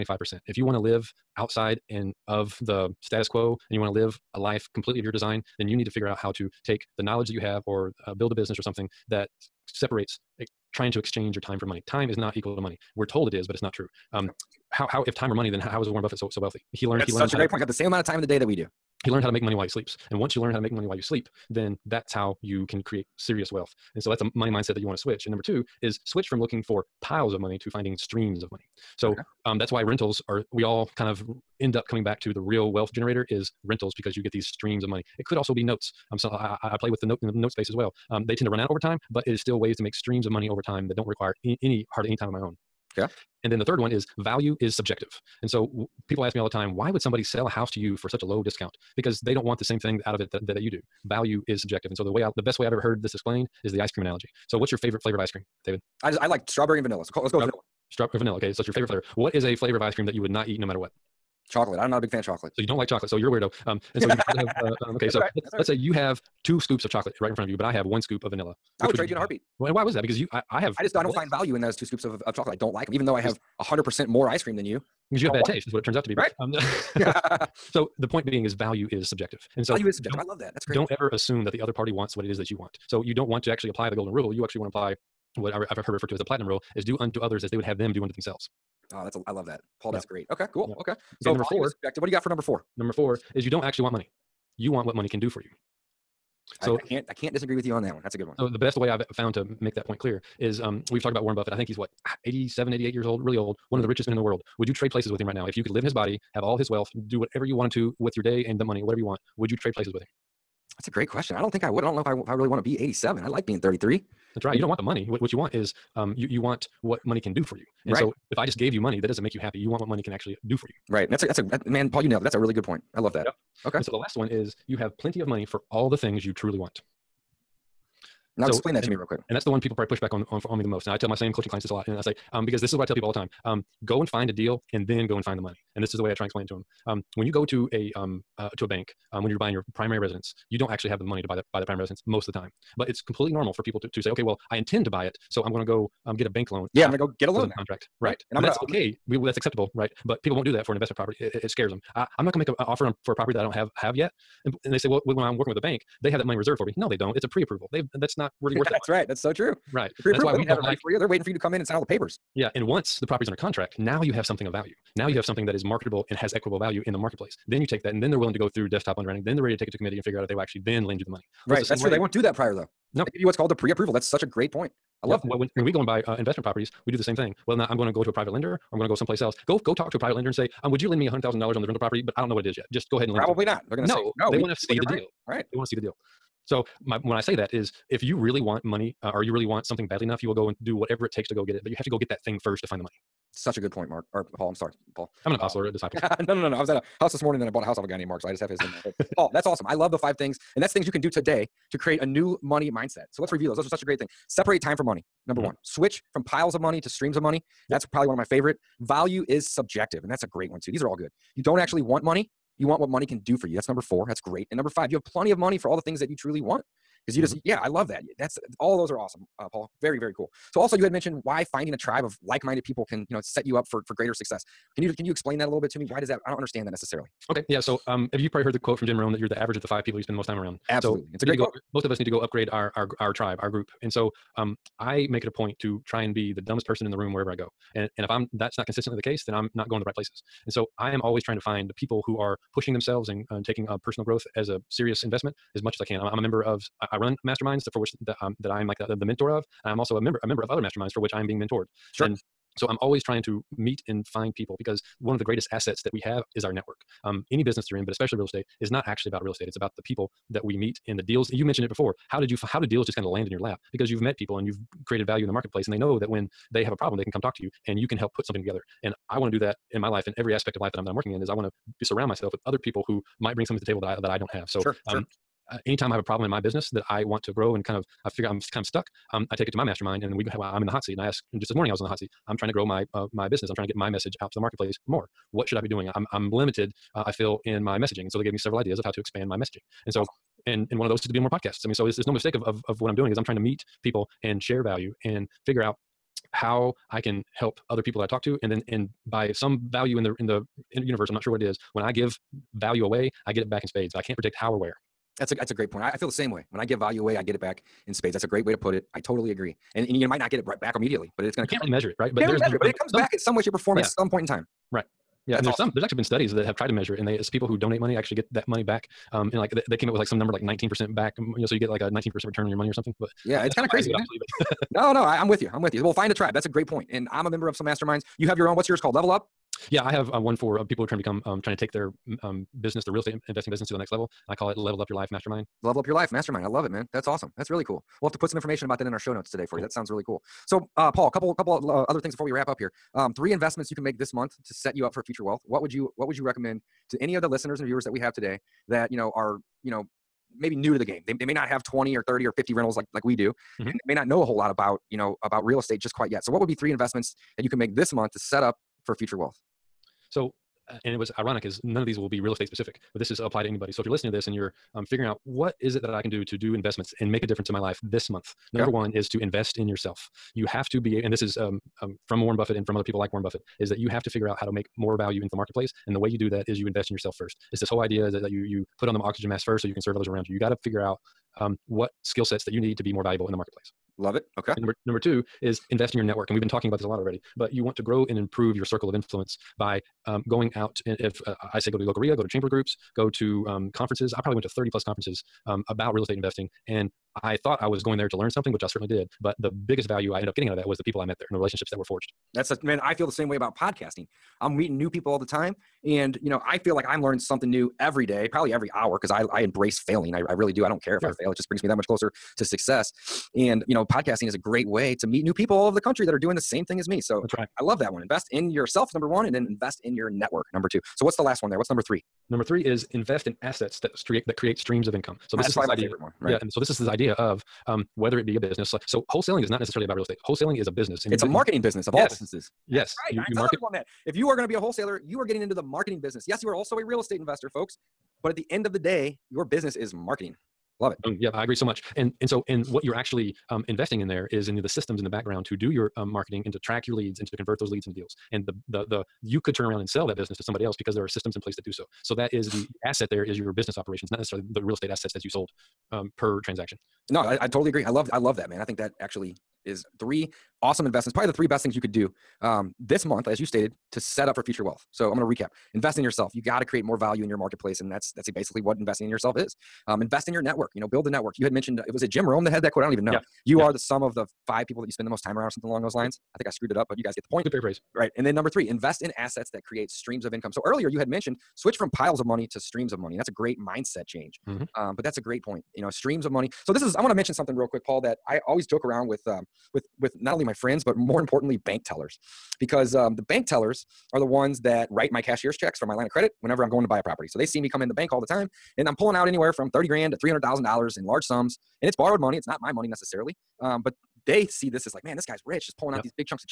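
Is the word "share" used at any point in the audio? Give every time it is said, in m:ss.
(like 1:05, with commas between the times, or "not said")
4:54.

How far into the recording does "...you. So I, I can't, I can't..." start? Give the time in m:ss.
1:35.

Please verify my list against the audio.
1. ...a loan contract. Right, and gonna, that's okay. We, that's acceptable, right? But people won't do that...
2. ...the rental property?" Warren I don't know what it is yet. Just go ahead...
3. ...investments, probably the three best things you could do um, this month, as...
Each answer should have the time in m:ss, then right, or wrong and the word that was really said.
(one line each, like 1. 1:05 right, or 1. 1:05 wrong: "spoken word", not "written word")
1. 2:27 right
2. 3:01 wrong: "But", not "Warren"
3. 7:40 right.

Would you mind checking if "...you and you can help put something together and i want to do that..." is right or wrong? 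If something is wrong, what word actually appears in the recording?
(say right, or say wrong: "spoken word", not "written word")
right.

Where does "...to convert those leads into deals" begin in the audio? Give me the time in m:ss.
7:27.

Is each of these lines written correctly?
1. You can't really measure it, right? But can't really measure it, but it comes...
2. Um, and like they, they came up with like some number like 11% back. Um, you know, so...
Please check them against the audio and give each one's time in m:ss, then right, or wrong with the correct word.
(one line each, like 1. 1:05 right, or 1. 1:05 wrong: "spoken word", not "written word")
1. 5:11 right
2. 5:19 wrong: "19", not "11".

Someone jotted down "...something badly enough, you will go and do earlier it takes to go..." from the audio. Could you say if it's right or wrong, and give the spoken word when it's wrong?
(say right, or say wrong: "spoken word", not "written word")
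wrong: "whatever", not "earlier".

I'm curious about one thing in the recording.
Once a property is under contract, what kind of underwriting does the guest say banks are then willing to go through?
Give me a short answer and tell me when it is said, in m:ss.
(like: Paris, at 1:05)
desktop underwriting, at 2:48.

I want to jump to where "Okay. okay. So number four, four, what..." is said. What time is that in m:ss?
1:30.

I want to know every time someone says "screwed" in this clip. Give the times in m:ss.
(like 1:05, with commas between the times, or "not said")
7:56.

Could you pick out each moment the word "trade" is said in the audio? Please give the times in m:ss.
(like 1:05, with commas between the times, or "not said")
1:08, 1:44, 1:49.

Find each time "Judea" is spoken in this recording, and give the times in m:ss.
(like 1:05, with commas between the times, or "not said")
not said.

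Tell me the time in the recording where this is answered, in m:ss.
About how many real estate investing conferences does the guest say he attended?
6:34.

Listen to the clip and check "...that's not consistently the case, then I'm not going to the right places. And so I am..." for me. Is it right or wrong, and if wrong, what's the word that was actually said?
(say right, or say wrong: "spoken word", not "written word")
right.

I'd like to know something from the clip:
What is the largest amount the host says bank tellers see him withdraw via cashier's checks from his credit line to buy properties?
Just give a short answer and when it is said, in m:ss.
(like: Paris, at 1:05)
$300,000, at 8:20.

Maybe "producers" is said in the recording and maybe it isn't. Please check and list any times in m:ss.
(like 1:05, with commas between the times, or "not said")
not said.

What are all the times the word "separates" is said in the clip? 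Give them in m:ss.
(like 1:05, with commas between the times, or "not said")
0:09, 3:24.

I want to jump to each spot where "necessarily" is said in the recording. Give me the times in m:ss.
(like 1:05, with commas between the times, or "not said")
3:46, 7:09, 7:34, 8:22.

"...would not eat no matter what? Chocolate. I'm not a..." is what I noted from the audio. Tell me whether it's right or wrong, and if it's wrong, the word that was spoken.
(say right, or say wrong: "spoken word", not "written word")
right.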